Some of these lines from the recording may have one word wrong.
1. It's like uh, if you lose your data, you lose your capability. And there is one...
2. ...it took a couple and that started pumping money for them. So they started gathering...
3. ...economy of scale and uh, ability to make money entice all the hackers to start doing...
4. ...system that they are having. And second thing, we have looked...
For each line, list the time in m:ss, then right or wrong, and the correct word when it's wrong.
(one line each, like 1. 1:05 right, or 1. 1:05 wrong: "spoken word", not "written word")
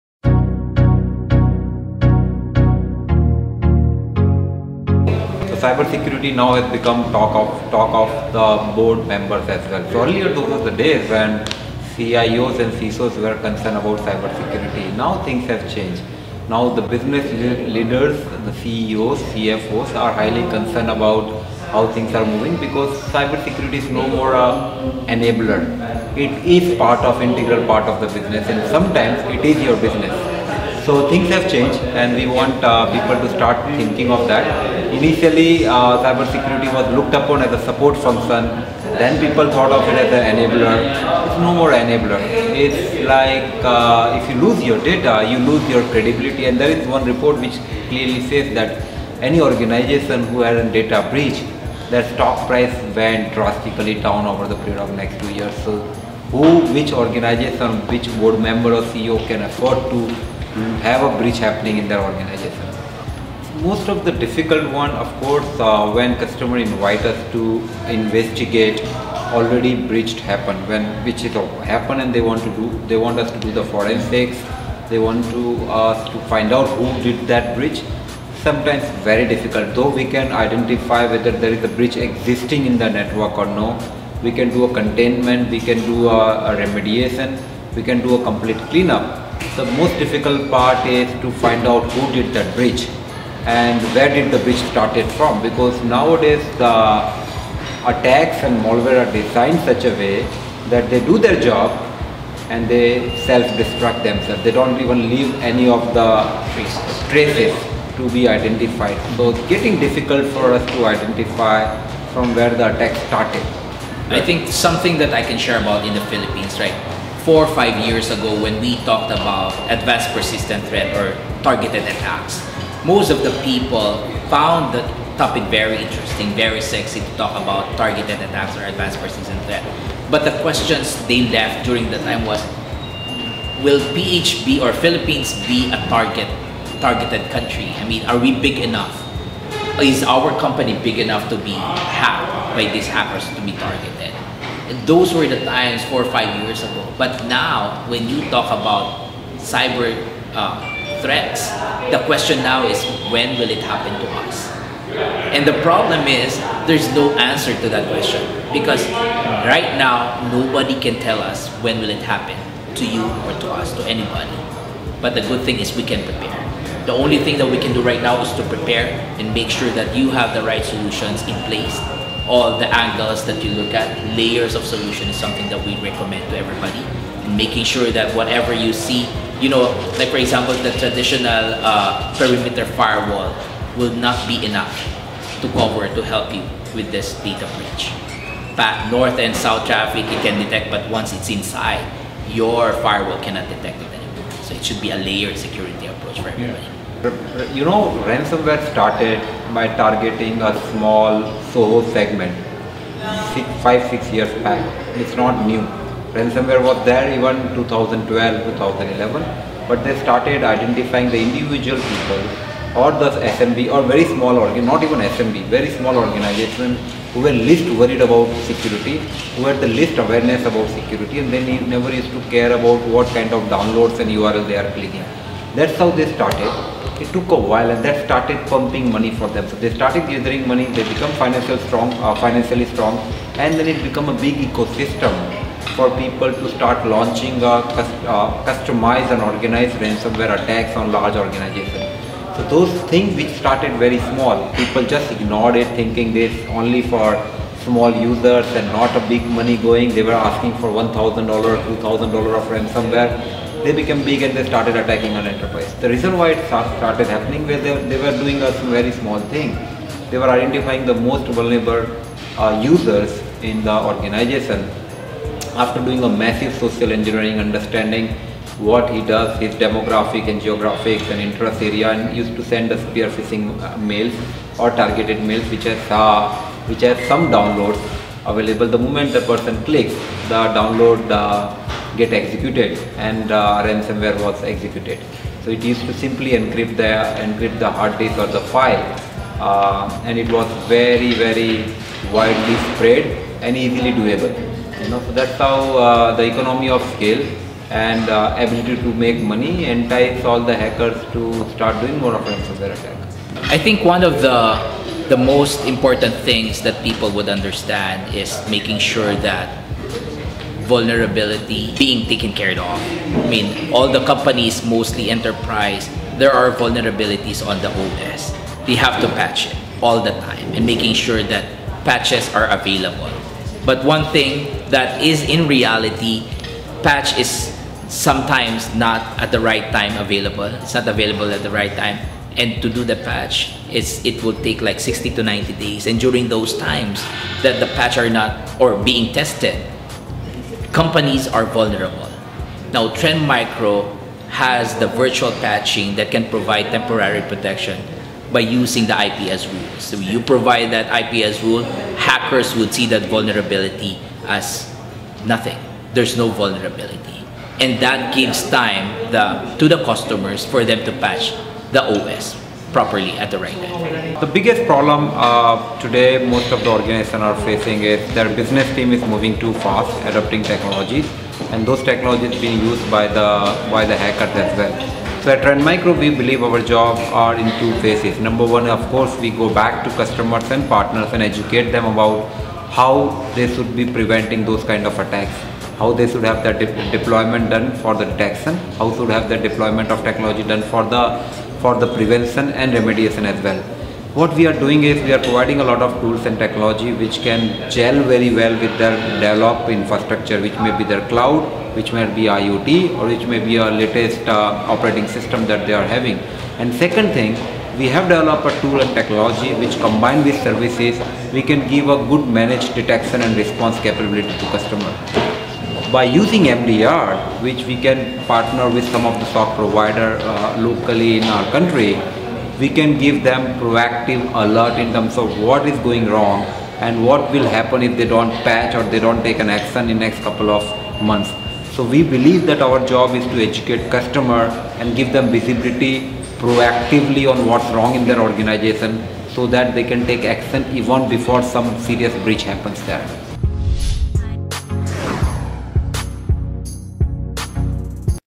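1. 0:42 wrong: "credibility", not "capability"
2. 3:47 wrong: "while", not "couple"
3. 4:56 right
4. 6:45 wrong: "developed", not "looked".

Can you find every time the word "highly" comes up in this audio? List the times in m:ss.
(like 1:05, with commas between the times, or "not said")
0:20.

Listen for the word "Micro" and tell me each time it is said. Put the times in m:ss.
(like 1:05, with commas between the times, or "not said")
5:43, 6:15.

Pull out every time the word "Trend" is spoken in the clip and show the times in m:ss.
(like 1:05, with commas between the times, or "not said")
5:42, 6:15.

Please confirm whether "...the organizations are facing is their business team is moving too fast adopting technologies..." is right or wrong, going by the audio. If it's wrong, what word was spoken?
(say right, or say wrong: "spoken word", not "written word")
right.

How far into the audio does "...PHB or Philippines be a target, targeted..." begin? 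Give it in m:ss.
2:13.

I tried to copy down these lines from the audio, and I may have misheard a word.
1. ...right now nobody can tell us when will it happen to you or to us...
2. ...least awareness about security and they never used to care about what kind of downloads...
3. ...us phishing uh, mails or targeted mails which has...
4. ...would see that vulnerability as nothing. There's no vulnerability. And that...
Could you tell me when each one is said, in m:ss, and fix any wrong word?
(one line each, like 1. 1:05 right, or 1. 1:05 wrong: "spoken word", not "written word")
1. 2:39 right
2. 3:39 right
3. 4:32 right
4. 5:52 right.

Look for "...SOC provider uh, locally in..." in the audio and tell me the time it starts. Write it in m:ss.
6:59.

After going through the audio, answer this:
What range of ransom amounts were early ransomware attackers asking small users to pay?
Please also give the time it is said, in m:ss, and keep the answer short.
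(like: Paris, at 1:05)
$1,000 to $2,000, at 4:10.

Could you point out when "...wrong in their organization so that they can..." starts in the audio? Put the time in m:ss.
7:17.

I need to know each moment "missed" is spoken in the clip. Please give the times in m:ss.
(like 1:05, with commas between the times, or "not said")
not said.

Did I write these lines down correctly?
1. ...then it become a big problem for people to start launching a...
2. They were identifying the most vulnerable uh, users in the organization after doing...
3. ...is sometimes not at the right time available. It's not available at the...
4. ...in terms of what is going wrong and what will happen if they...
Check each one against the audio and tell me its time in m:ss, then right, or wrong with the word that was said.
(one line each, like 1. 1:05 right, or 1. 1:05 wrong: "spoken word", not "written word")
1. 3:53 wrong: "ecosystem", not "problem"
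2. 4:20 right
3. 5:27 right
4. 7:04 right.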